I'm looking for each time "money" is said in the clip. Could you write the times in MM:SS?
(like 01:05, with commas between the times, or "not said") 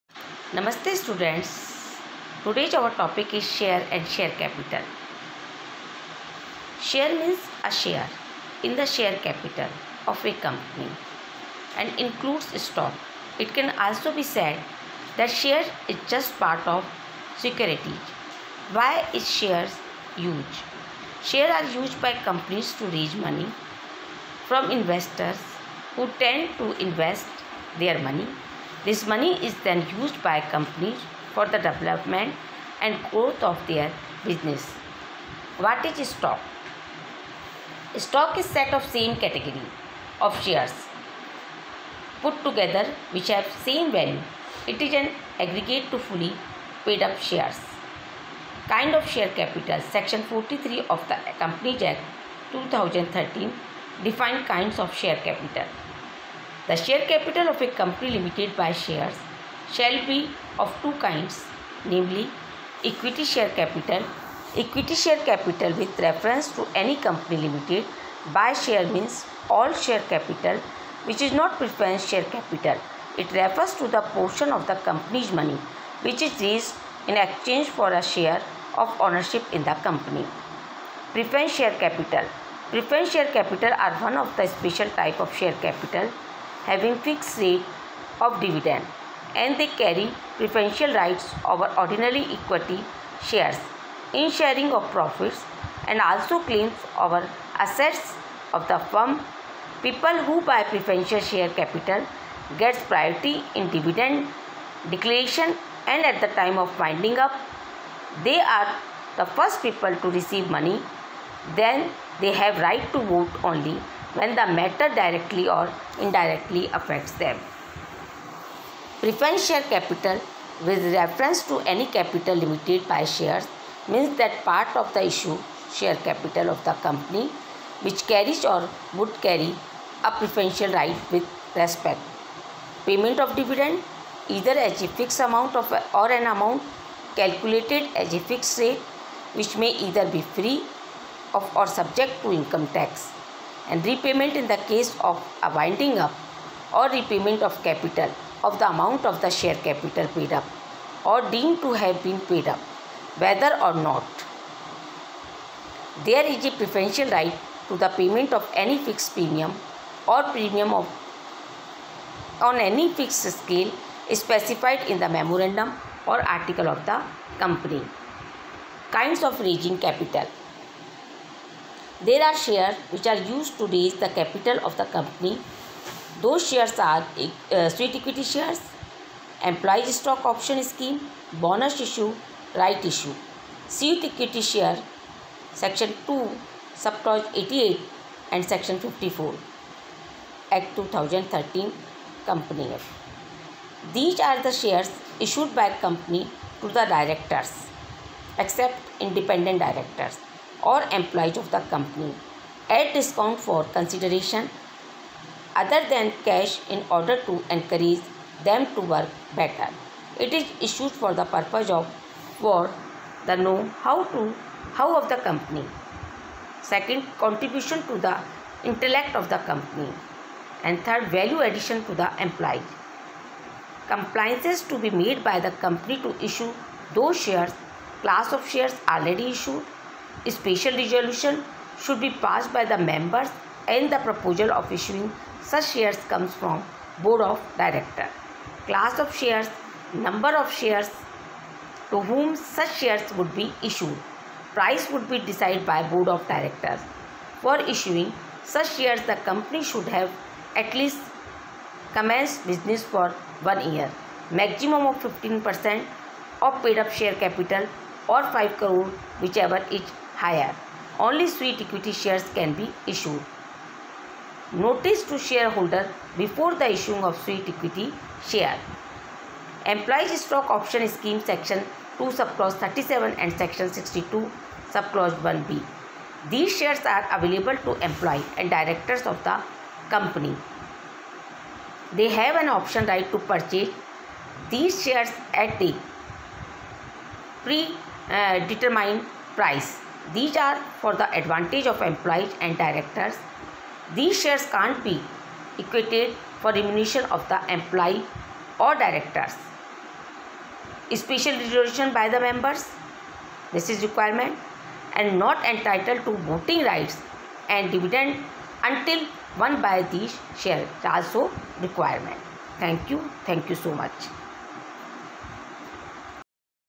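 00:29, 01:15, 01:50.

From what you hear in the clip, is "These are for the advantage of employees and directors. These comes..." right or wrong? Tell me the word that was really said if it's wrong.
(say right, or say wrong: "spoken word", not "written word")
wrong: "shares", not "comes".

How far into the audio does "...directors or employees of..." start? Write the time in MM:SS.
03:19.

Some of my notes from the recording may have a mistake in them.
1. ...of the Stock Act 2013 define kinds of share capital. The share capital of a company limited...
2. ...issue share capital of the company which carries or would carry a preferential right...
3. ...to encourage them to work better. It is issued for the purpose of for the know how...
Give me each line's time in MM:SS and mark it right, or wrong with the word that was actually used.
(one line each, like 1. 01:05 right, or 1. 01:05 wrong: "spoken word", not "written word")
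1. 00:50 wrong: "Companies", not "Stock"
2. 02:05 right
3. 03:27 right.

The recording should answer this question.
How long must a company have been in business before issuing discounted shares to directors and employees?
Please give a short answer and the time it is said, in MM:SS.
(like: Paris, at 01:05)
1 year, at 04:13.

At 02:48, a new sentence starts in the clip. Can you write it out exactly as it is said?
Kinds of raising capital there are shares which are used to raise the capital of the company.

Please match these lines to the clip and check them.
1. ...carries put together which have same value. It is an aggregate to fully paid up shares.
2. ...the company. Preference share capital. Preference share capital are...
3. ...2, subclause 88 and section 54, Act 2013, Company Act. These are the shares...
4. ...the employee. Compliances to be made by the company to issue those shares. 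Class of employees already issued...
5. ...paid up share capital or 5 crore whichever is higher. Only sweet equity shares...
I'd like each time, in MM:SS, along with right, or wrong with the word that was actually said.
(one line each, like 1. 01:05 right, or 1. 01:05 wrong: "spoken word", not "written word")
1. 00:40 wrong: "shares", not "carries"
2. 01:19 right
3. 03:06 right
4. 03:41 wrong: "shares", not "employees"
5. 04:16 right.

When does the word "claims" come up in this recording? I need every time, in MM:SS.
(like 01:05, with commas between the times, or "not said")
01:36.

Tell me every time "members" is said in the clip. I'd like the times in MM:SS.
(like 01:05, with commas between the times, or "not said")
03:52, 05:02.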